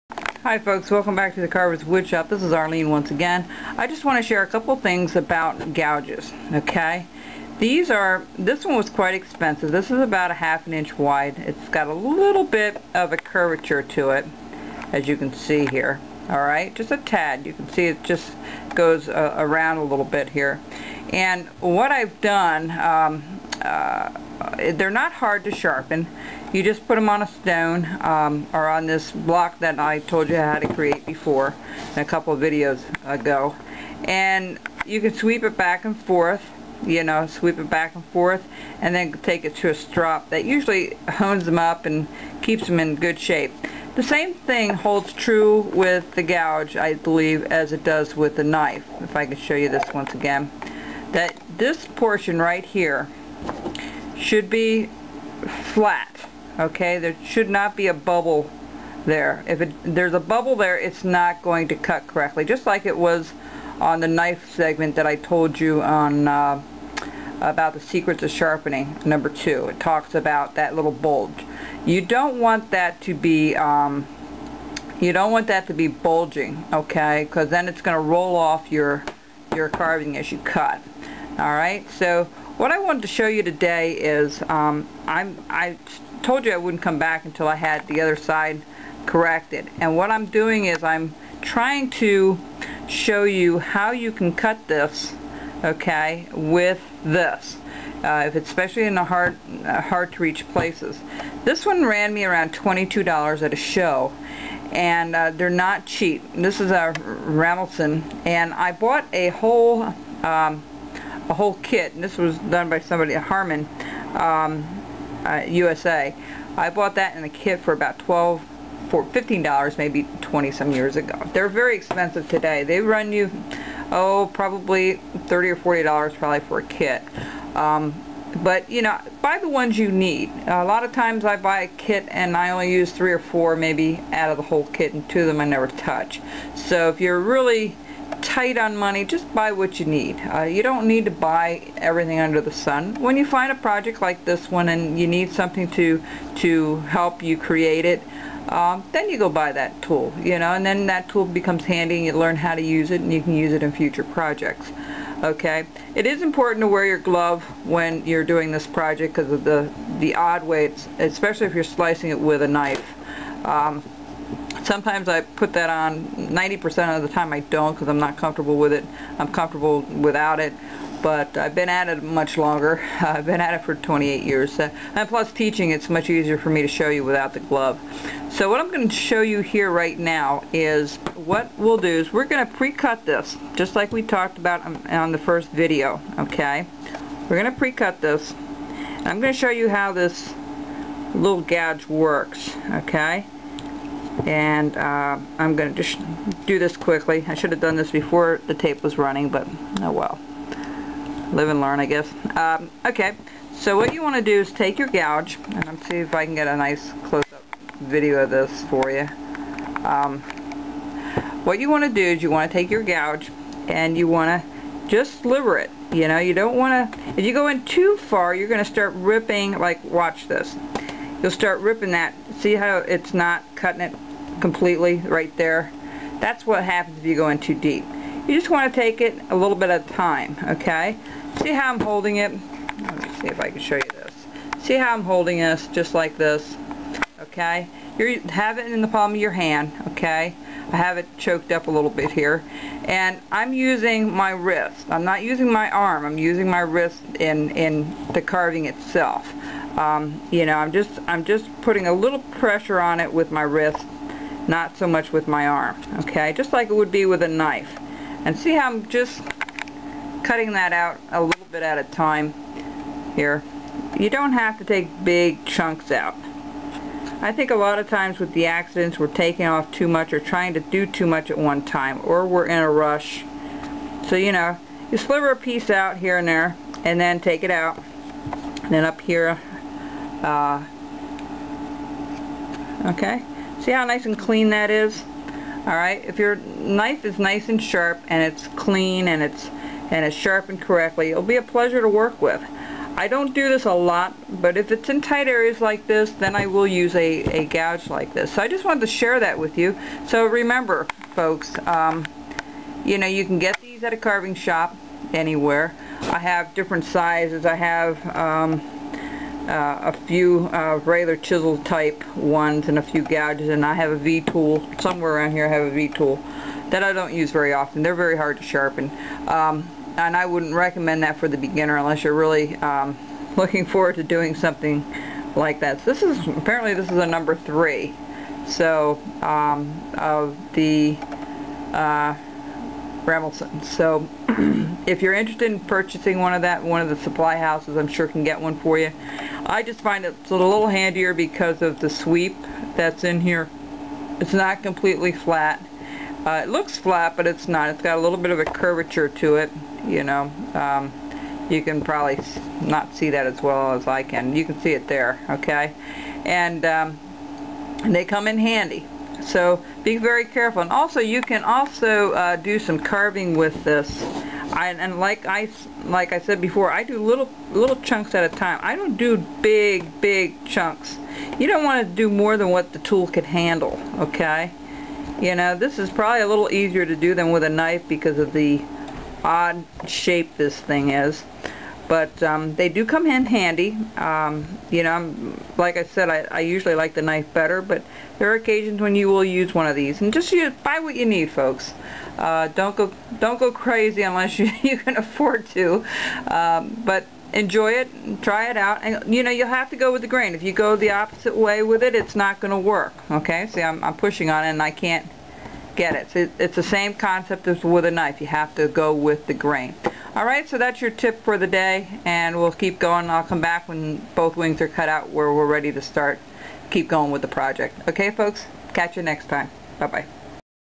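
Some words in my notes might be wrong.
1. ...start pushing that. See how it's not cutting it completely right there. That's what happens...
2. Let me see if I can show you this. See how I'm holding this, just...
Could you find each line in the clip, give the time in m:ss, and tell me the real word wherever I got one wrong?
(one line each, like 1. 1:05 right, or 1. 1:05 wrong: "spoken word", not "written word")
1. 3:41 wrong: "ripping", not "pushing"
2. 3:52 right.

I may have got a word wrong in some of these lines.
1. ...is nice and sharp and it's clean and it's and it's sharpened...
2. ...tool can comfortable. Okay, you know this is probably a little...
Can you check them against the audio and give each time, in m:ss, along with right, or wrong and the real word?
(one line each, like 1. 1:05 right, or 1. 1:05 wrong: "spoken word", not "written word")
1. 4:47 right
2. 6:12 wrong: "handle", not "comfortable".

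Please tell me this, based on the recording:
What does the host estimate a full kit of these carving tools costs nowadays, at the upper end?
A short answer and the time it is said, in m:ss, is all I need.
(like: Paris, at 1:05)
$40, at 2:05.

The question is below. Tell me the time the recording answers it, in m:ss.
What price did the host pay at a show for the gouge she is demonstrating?
1:42.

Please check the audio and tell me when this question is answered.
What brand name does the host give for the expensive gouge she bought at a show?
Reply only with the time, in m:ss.
1:46.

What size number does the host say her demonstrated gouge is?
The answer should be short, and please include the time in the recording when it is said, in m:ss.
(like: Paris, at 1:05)
3, at 5:27.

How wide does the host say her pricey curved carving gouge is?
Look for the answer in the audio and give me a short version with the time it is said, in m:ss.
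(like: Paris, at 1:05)
half an inch, at 0:10.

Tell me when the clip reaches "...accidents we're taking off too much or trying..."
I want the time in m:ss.
4:28.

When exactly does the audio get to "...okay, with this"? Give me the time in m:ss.
1:35.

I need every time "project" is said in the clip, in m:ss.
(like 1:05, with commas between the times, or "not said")
2:23, 2:34, 2:38, 6:57.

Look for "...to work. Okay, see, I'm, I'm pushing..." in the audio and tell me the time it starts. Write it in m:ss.
6:42.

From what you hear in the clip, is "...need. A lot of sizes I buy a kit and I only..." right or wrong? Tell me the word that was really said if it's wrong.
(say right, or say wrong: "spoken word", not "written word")
wrong: "times", not "sizes".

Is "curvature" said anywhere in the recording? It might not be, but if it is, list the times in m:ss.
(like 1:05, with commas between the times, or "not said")
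0:13, 5:48.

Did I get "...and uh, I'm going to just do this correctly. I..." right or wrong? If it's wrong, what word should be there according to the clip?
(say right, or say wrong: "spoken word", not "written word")
wrong: "quickly", not "correctly".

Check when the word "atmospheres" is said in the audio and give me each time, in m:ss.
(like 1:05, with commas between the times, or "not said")
not said.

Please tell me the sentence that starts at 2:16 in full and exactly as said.
So if you're really tight on money, just buy what you need.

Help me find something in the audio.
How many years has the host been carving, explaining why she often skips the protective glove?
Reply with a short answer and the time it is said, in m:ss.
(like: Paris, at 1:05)
28, at 2:53.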